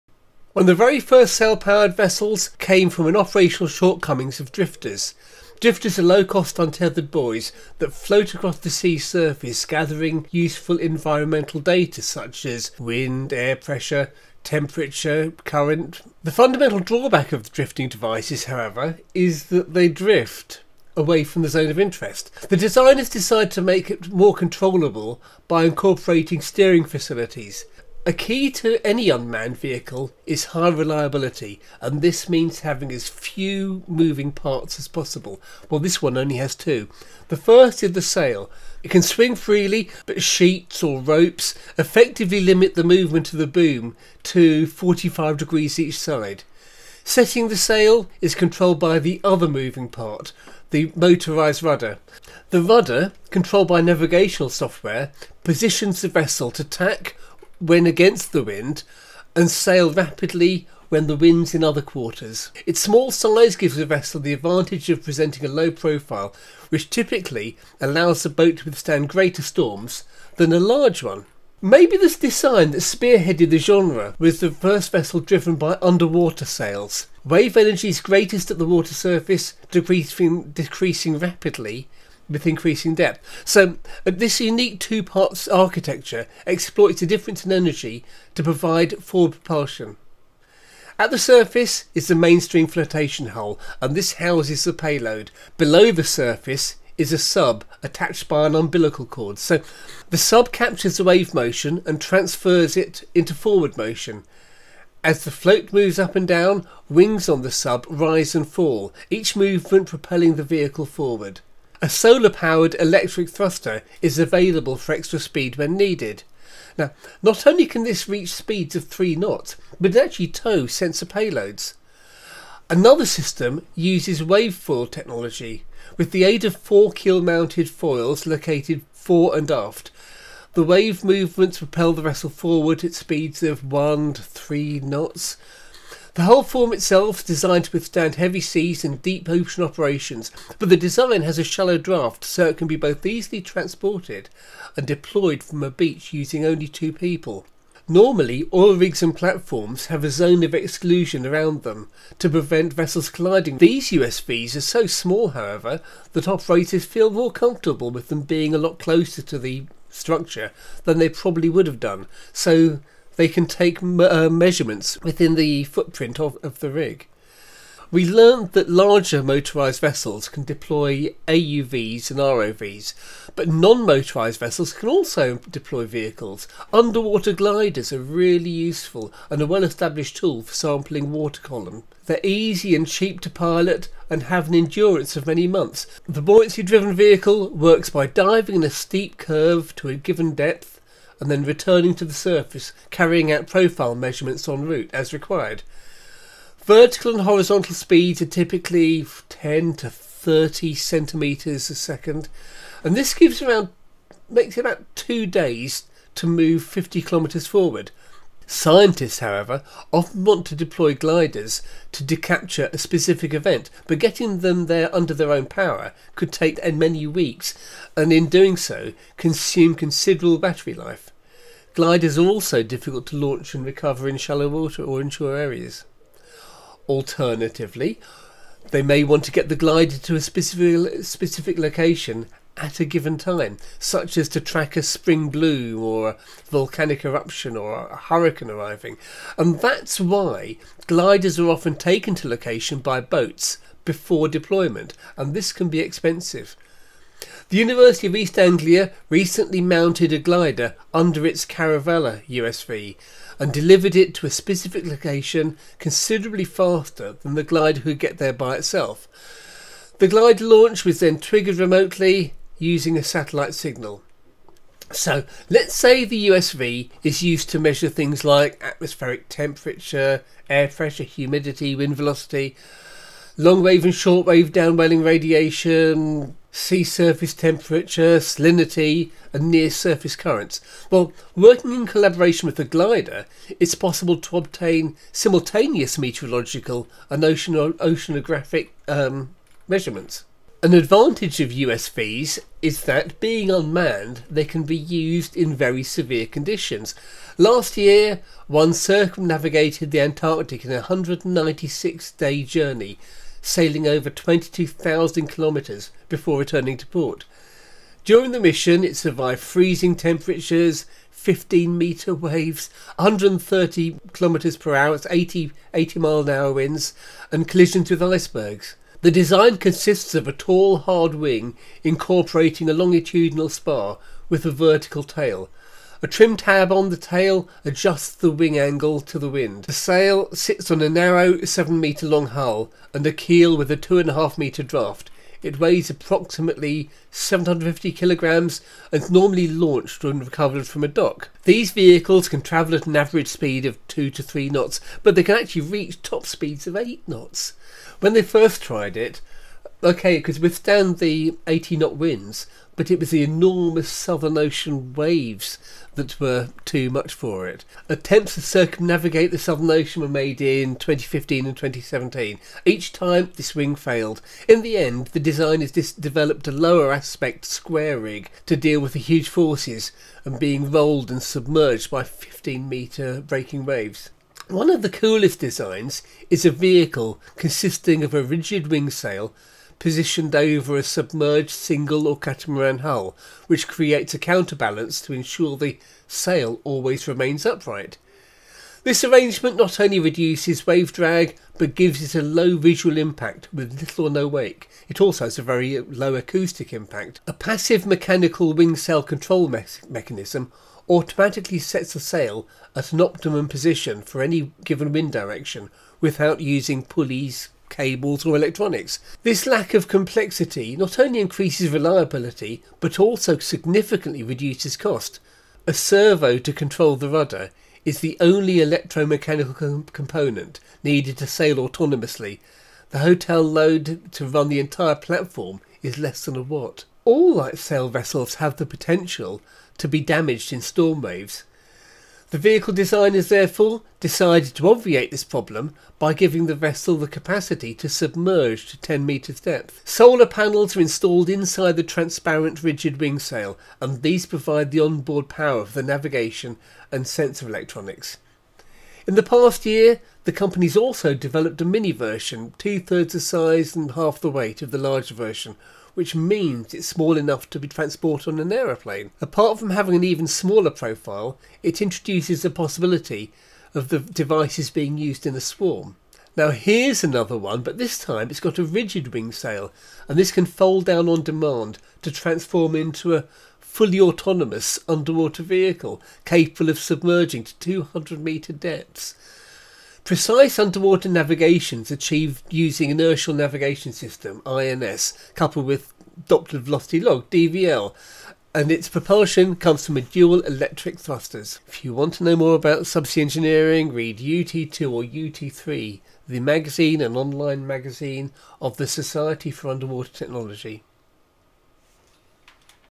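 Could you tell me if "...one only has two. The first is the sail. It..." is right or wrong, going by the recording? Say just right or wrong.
right.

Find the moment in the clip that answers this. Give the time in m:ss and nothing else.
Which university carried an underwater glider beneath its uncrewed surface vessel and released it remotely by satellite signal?
4:07.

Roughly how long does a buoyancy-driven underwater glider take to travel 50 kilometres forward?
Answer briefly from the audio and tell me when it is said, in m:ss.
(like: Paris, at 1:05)
about 2 days, at 3:24.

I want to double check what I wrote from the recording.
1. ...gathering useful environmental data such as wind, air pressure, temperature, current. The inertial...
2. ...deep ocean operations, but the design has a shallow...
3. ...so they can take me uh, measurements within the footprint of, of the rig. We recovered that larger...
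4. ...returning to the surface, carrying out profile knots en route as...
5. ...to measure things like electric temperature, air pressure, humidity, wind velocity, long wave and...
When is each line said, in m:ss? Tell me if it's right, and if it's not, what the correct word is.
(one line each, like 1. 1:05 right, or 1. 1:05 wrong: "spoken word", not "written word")
1. 0:09 wrong: "fundamental", not "inertial"
2. 2:19 right
3. 2:42 wrong: "learned", not "recovered"
4. 3:11 wrong: "measurements", not "knots"
5. 4:27 wrong: "atmospheric", not "electric".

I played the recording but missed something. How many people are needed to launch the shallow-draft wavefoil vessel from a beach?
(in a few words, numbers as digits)
2.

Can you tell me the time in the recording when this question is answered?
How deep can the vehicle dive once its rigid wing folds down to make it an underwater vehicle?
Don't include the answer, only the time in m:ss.
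7:57.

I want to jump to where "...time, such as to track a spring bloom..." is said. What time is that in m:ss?
3:53.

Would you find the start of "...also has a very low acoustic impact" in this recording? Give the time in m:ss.
6:35.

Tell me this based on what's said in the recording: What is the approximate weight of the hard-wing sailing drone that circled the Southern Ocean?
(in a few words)
750 kilograms.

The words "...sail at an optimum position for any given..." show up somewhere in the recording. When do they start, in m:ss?
6:41.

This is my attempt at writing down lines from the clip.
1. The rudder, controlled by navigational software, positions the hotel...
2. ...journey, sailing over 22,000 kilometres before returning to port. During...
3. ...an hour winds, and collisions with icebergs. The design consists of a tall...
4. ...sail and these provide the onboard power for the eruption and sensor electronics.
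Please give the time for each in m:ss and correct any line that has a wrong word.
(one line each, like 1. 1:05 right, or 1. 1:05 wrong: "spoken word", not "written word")
1. 0:52 wrong: "vessel", not "hotel"
2. 5:02 right
3. 5:16 right
4. 7:23 wrong: "navigation", not "eruption".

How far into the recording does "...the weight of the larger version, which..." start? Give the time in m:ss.
7:34.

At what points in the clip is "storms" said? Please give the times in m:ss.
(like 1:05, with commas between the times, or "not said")
1:09, 7:10.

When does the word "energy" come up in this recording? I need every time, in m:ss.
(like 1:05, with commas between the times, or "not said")
1:17, 1:27.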